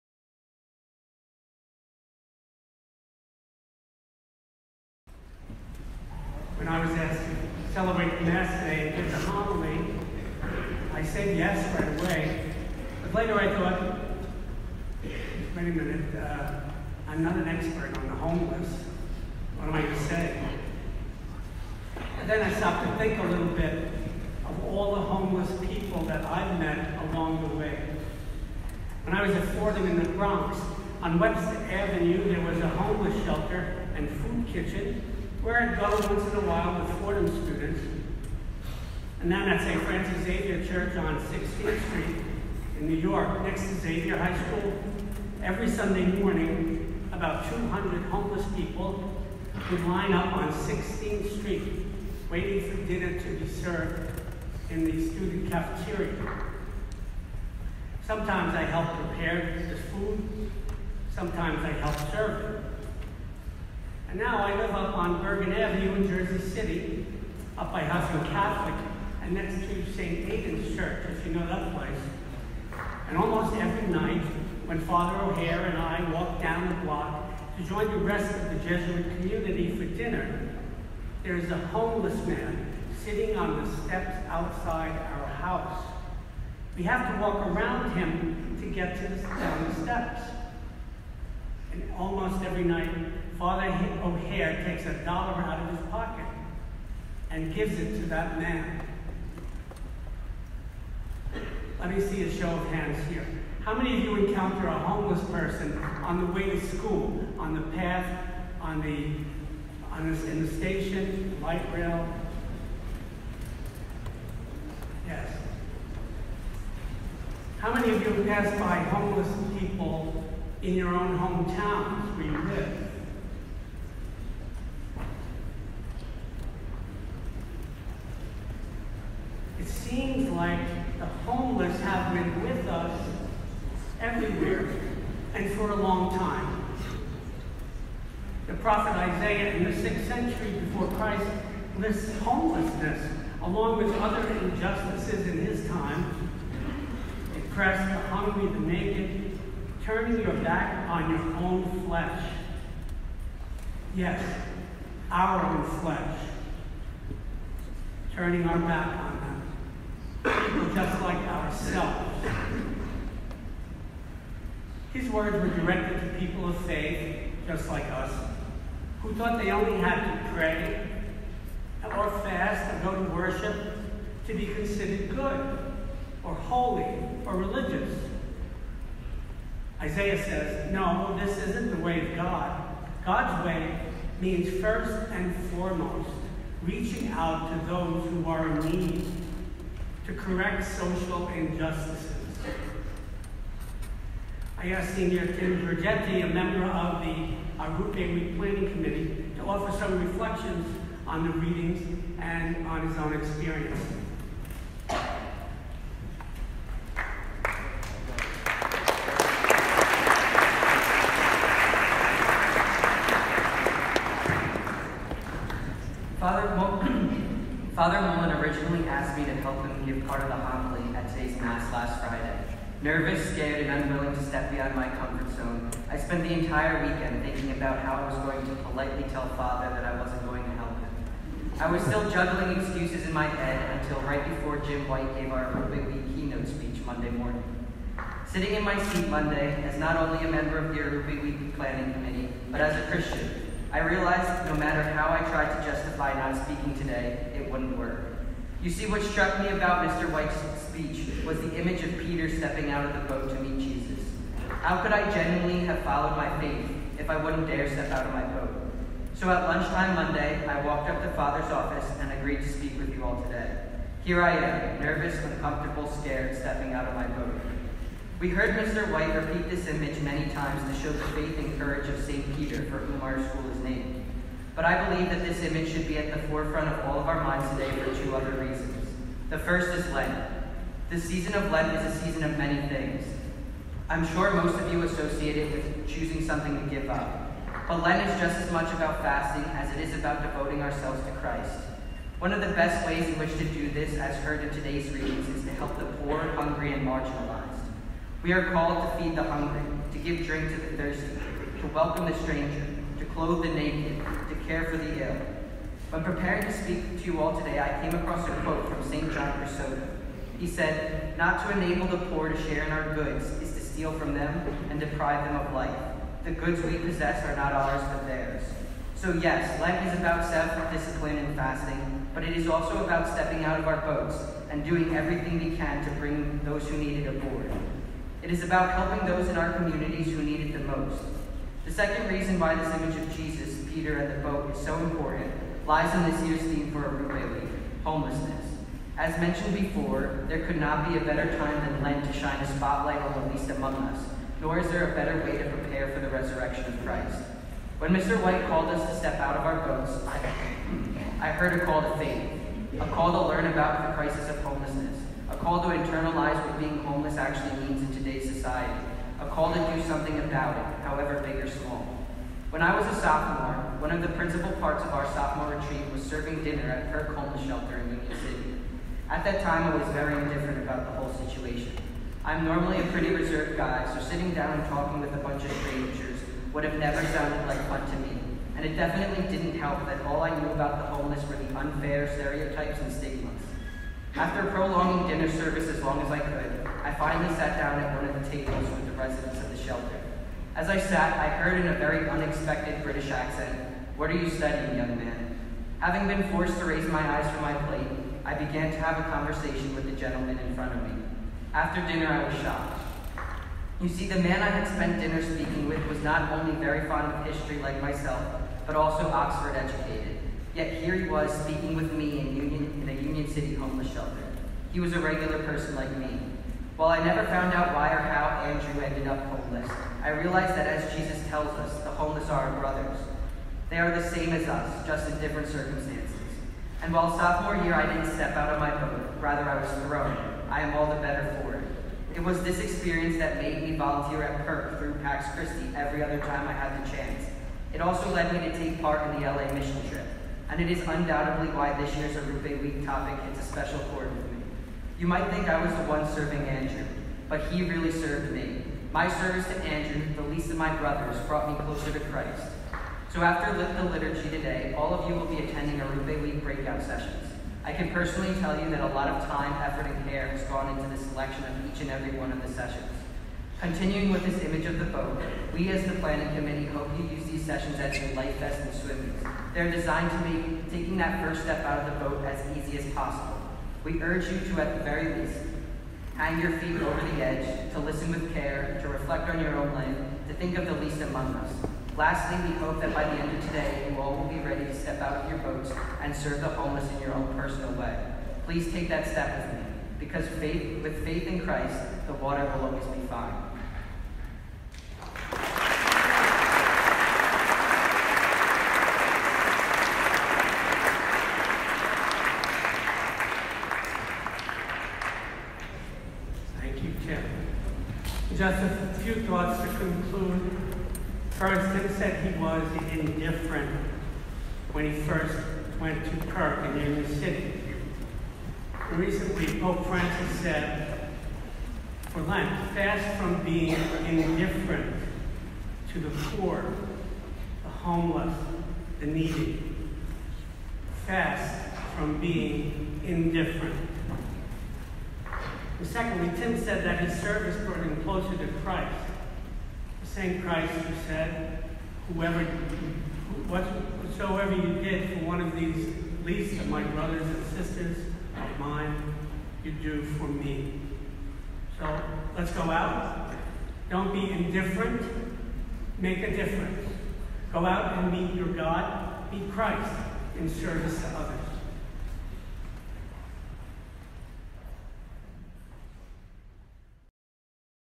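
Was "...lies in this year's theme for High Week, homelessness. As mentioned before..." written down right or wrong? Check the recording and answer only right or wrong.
wrong.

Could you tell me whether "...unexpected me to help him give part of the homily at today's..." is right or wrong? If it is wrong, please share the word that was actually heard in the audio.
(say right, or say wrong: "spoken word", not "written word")
wrong: "asked", not "unexpected".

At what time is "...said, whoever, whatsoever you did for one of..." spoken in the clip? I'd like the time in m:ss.
9:01.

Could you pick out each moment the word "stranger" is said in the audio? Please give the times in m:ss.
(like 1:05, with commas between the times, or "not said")
5:02, 6:15.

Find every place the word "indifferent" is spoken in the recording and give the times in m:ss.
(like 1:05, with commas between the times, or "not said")
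6:10, 8:44, 8:53, 9:14.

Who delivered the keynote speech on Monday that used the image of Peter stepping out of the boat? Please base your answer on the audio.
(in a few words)
Jim White.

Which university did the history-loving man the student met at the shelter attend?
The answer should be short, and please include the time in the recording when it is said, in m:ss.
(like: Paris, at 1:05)
Oxford, at 6:49.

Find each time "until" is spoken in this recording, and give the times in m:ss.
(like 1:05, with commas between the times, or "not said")
3:53.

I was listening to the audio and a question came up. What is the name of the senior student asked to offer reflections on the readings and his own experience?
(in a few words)
Tim Georgetti.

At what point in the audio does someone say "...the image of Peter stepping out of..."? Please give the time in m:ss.
4:11.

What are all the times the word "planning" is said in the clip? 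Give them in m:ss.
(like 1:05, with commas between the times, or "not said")
3:18, 4:01, 7:45.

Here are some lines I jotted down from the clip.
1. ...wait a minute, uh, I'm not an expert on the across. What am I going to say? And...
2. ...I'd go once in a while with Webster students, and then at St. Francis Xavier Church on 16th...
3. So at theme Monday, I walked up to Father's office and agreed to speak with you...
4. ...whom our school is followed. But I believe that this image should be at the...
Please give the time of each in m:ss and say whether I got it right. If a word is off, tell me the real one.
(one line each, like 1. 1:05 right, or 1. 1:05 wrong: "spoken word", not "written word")
1. 0:15 wrong: "homeless", not "across"
2. 0:35 wrong: "Fordham", not "Webster"
3. 4:19 wrong: "lunchtime", not "theme"
4. 4:32 wrong: "named", not "followed".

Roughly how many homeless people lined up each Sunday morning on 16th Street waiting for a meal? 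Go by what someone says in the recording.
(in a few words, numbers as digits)
200.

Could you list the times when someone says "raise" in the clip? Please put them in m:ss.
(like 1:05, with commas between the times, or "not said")
6:36.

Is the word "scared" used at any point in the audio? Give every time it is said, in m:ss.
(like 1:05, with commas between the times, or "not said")
3:43, 4:25.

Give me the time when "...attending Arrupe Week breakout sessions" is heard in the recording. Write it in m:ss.
7:35.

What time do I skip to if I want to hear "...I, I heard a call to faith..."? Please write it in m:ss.
5:50.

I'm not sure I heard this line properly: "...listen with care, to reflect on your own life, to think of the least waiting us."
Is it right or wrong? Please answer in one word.
wrong.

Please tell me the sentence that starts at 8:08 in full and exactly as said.
Please take that step with me, because faith, with faith in Christ, the water will always be fine.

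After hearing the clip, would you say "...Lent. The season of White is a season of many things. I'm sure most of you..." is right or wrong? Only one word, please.
wrong.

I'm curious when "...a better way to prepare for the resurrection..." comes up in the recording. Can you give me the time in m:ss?
5:44.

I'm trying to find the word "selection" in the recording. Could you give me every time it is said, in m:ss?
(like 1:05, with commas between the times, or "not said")
7:41.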